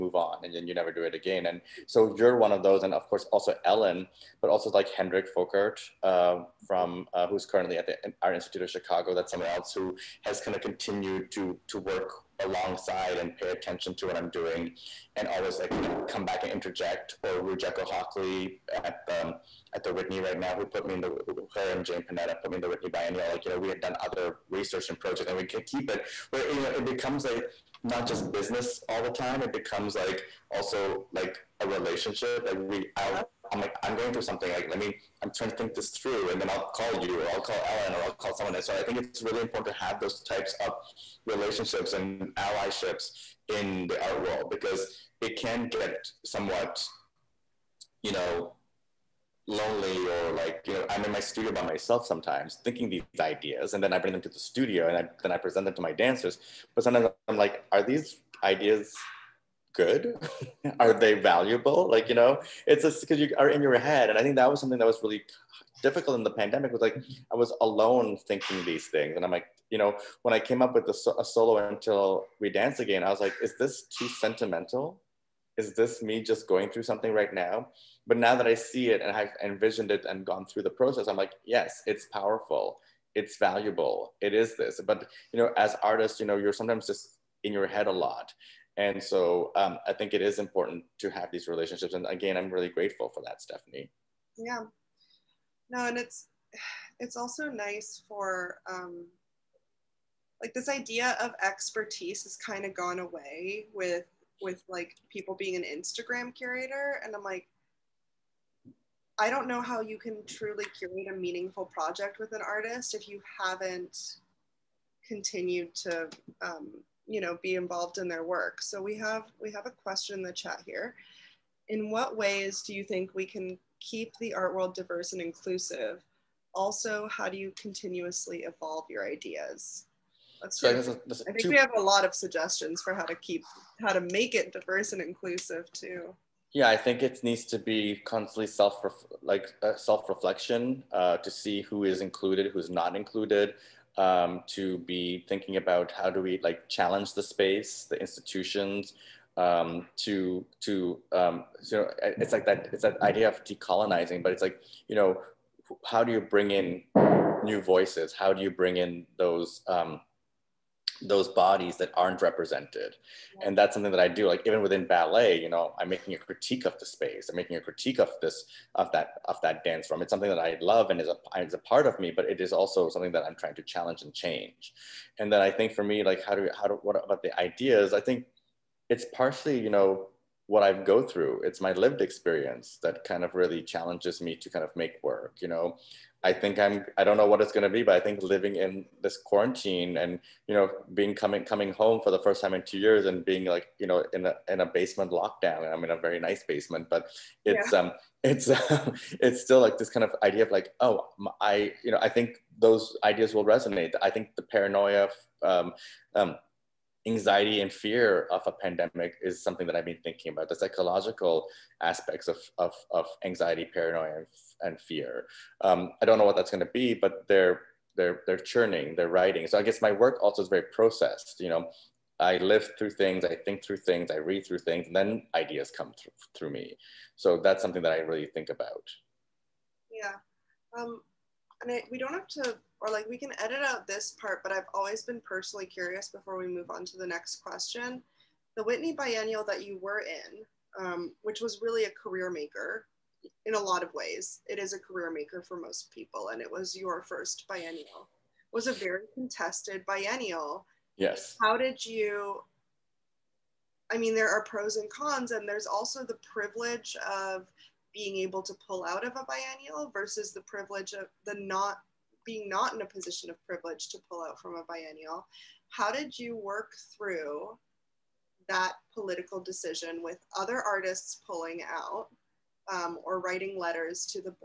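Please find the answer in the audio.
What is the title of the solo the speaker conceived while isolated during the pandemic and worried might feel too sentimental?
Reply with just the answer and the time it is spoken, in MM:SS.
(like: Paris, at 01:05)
Until We Dance Again, at 01:11.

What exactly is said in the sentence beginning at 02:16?
Yeah, I think it needs to be constantly self like uh, self reflection uh, to see who is included, who's not included.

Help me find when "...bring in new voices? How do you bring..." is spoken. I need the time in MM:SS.
02:36.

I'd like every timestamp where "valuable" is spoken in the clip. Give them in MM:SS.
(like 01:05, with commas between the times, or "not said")
01:01, 01:23.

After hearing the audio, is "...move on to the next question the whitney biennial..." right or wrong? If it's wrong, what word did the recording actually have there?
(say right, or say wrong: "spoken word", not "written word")
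right.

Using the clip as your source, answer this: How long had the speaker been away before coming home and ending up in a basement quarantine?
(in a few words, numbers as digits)
2 years.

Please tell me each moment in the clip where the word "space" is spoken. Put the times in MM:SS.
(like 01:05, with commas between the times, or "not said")
02:27, 02:46.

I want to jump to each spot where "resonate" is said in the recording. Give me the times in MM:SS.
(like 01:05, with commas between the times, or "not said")
03:23.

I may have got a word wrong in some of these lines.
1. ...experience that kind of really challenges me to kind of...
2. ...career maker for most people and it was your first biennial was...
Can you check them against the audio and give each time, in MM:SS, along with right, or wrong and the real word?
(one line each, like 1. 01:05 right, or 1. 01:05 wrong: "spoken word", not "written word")
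1. 03:02 right
2. 04:04 right.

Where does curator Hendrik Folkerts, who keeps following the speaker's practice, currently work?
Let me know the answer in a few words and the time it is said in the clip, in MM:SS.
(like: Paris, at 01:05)
Art Institute of Chicago, at 00:08.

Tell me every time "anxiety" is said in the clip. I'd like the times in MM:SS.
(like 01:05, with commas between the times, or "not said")
03:27, 03:33.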